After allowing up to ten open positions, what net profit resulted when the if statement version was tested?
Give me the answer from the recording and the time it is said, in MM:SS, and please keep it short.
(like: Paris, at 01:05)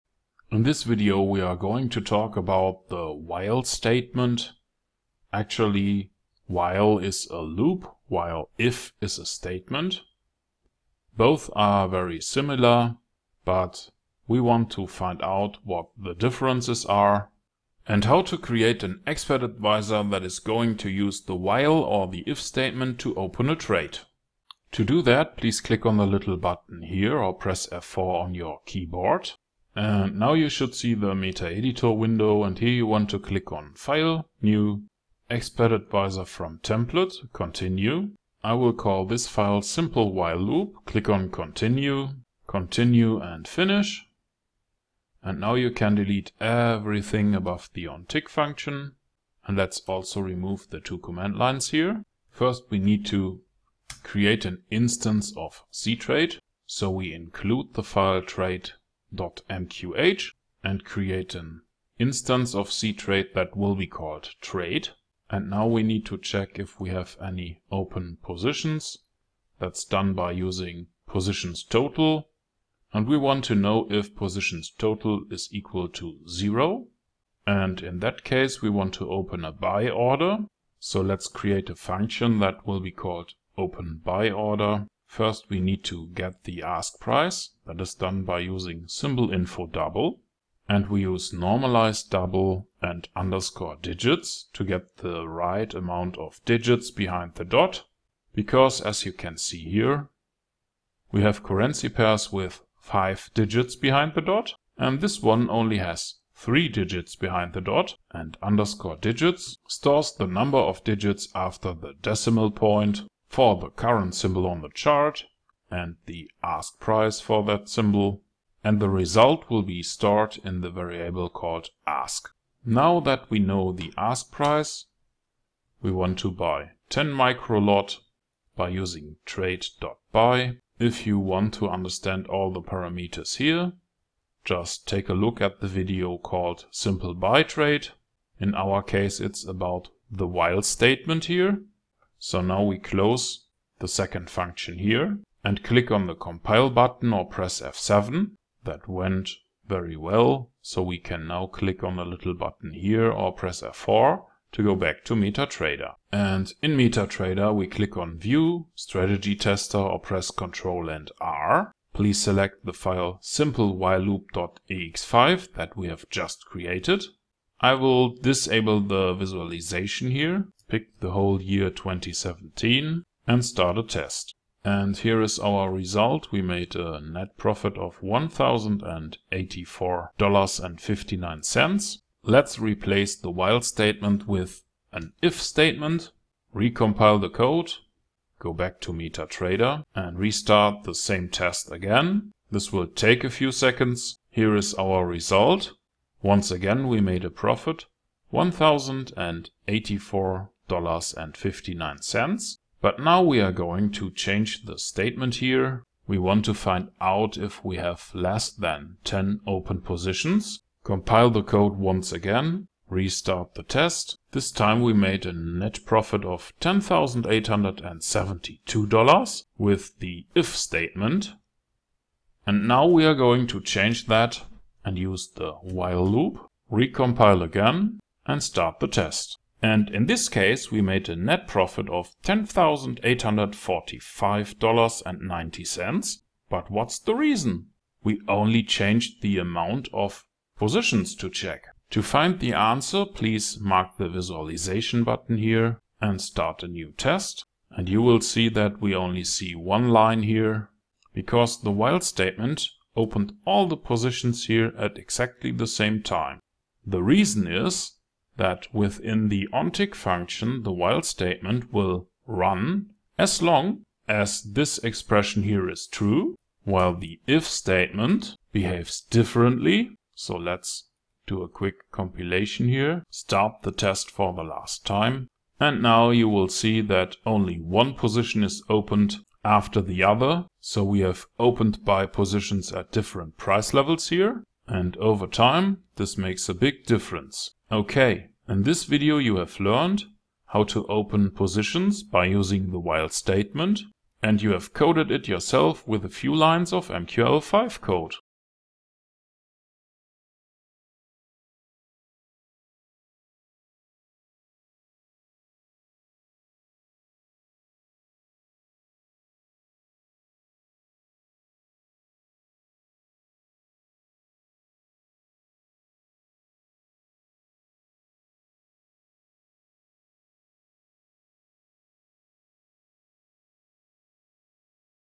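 $10,872, at 03:36.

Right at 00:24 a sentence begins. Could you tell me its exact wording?
To do that, please click on the little button here or press F4 on your keyboard.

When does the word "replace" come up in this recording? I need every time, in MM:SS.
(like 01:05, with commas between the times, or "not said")
03:02.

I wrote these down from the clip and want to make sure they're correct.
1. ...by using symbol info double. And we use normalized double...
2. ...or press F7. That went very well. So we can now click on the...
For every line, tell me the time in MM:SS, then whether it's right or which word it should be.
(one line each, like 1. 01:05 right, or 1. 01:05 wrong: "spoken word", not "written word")
1. 01:28 right
2. 02:27 right.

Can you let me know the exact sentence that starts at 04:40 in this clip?
So we have opened buy positions at different price levels here.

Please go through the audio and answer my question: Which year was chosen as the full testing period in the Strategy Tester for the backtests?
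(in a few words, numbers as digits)
2017.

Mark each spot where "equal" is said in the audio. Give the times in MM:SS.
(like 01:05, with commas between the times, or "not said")
01:15.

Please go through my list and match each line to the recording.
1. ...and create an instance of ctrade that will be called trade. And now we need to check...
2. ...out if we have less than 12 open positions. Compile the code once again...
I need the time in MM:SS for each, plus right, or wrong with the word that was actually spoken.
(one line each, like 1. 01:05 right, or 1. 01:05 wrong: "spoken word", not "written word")
1. 01:00 right
2. 03:26 wrong: "10", not "12".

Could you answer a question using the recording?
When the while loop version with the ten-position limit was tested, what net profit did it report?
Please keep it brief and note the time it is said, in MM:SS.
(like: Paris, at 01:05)
$10,845.90, at 03:52.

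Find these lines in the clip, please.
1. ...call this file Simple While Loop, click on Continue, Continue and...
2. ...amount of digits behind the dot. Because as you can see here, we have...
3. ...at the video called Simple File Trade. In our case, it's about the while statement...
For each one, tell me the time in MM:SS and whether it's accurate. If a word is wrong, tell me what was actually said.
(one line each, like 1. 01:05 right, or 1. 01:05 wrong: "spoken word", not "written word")
1. 00:38 right
2. 01:35 right
3. 02:15 wrong: "Buy", not "File".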